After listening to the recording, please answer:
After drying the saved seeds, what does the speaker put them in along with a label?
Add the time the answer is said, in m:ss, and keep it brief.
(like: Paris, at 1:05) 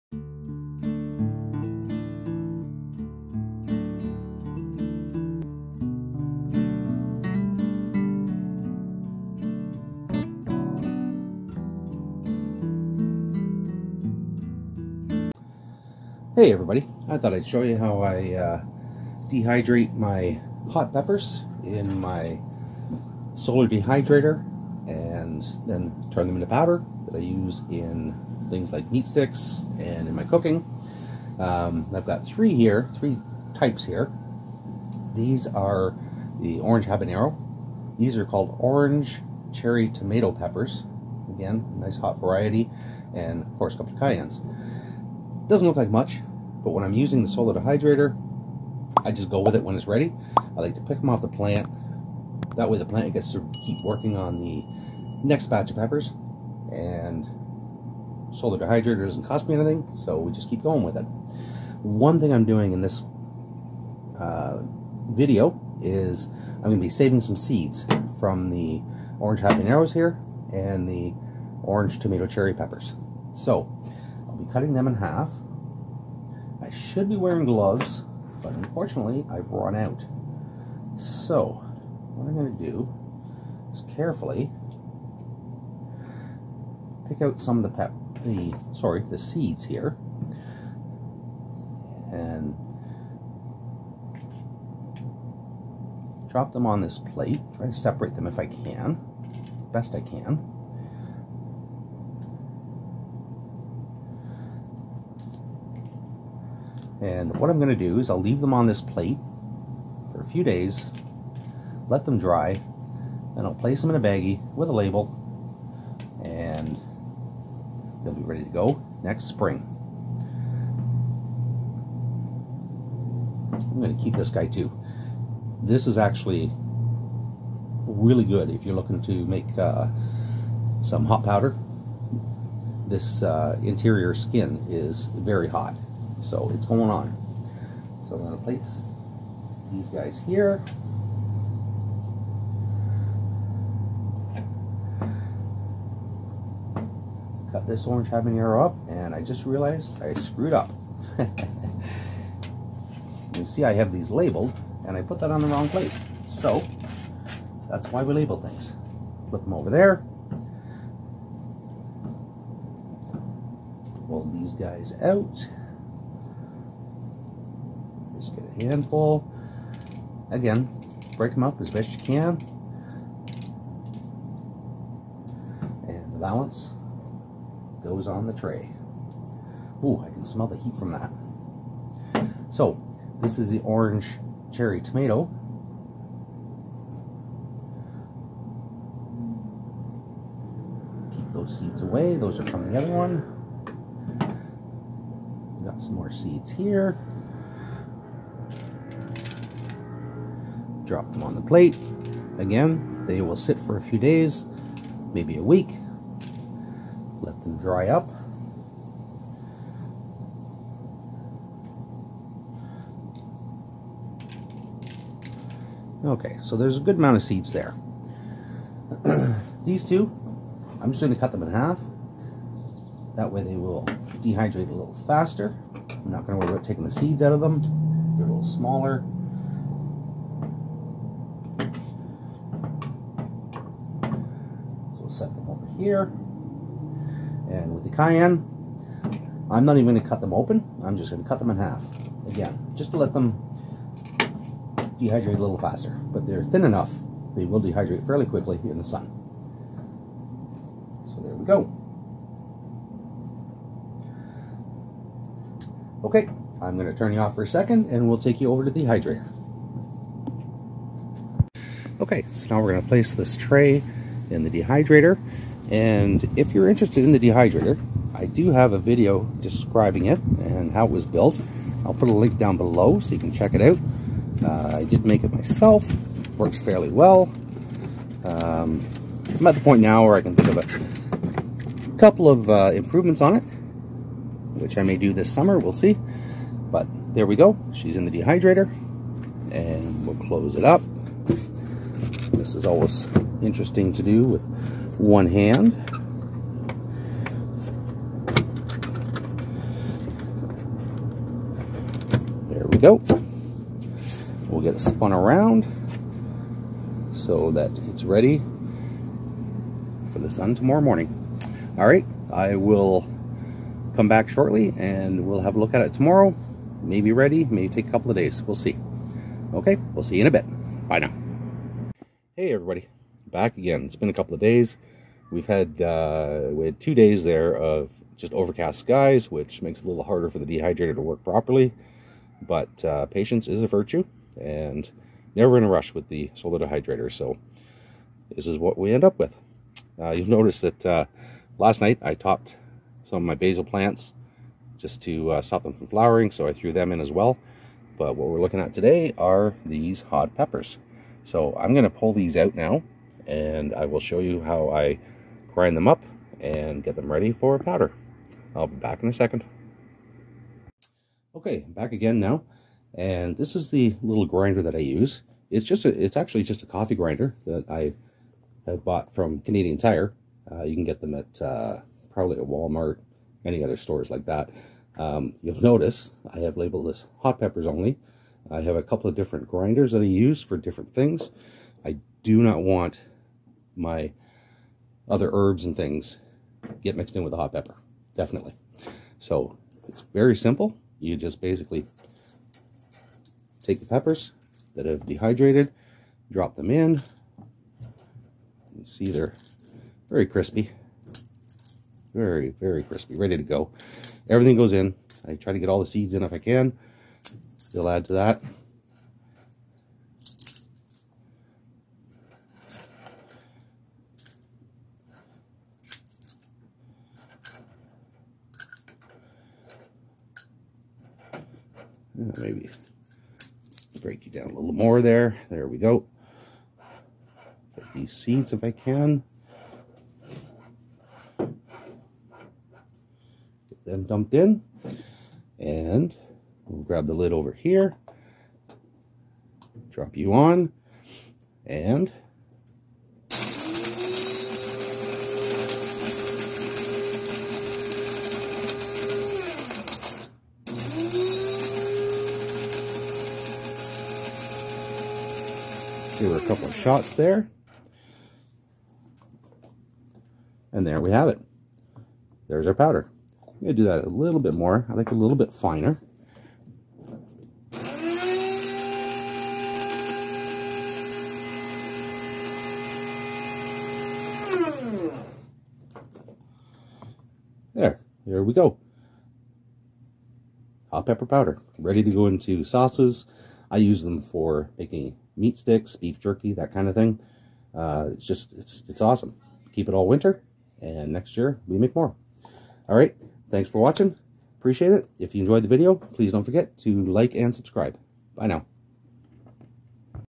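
A baggie, at 1:53.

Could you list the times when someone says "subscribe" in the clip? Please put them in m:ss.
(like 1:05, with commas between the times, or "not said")
8:17.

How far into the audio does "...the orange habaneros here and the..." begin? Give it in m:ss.
1:08.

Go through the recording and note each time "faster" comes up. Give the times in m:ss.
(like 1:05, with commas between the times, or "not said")
3:45, 4:05.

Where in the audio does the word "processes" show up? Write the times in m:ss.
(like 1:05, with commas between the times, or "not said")
not said.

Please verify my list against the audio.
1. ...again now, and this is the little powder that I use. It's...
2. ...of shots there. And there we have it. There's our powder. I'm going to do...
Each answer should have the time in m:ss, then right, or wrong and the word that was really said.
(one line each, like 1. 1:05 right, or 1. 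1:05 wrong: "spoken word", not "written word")
1. 6:01 wrong: "grinder", not "powder"
2. 7:36 right.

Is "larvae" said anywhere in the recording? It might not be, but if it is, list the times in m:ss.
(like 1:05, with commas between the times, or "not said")
not said.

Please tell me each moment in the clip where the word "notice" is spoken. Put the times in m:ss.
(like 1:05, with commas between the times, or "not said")
5:40, 6:15.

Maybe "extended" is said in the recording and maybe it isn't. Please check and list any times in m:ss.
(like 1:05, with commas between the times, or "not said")
not said.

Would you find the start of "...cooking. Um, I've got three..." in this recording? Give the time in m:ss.
0:30.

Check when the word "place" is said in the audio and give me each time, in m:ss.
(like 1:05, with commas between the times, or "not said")
1:53, 2:18, 4:22.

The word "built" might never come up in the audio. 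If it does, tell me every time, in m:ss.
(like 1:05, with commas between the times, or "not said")
4:31.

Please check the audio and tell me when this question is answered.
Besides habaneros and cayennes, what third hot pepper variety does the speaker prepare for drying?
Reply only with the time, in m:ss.
0:38.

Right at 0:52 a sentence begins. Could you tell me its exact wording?
That way the plant gets to keep working on the next batch of peppers.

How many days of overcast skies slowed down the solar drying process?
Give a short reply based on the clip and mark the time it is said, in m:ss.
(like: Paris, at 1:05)
2, at 5:26.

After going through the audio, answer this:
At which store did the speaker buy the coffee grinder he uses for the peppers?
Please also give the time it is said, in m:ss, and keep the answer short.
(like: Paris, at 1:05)
Canadian Tire, at 6:09.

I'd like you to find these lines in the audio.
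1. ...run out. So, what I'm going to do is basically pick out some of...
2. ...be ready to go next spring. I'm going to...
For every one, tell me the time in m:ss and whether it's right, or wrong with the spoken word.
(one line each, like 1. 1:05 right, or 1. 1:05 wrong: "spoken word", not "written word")
1. 1:19 wrong: "carefully", not "basically"
2. 1:58 right.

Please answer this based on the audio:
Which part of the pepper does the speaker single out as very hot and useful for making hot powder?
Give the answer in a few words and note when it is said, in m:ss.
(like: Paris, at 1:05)
Interior skin, at 2:13.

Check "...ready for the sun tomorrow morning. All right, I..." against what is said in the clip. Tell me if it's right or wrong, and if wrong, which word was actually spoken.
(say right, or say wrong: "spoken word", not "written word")
right.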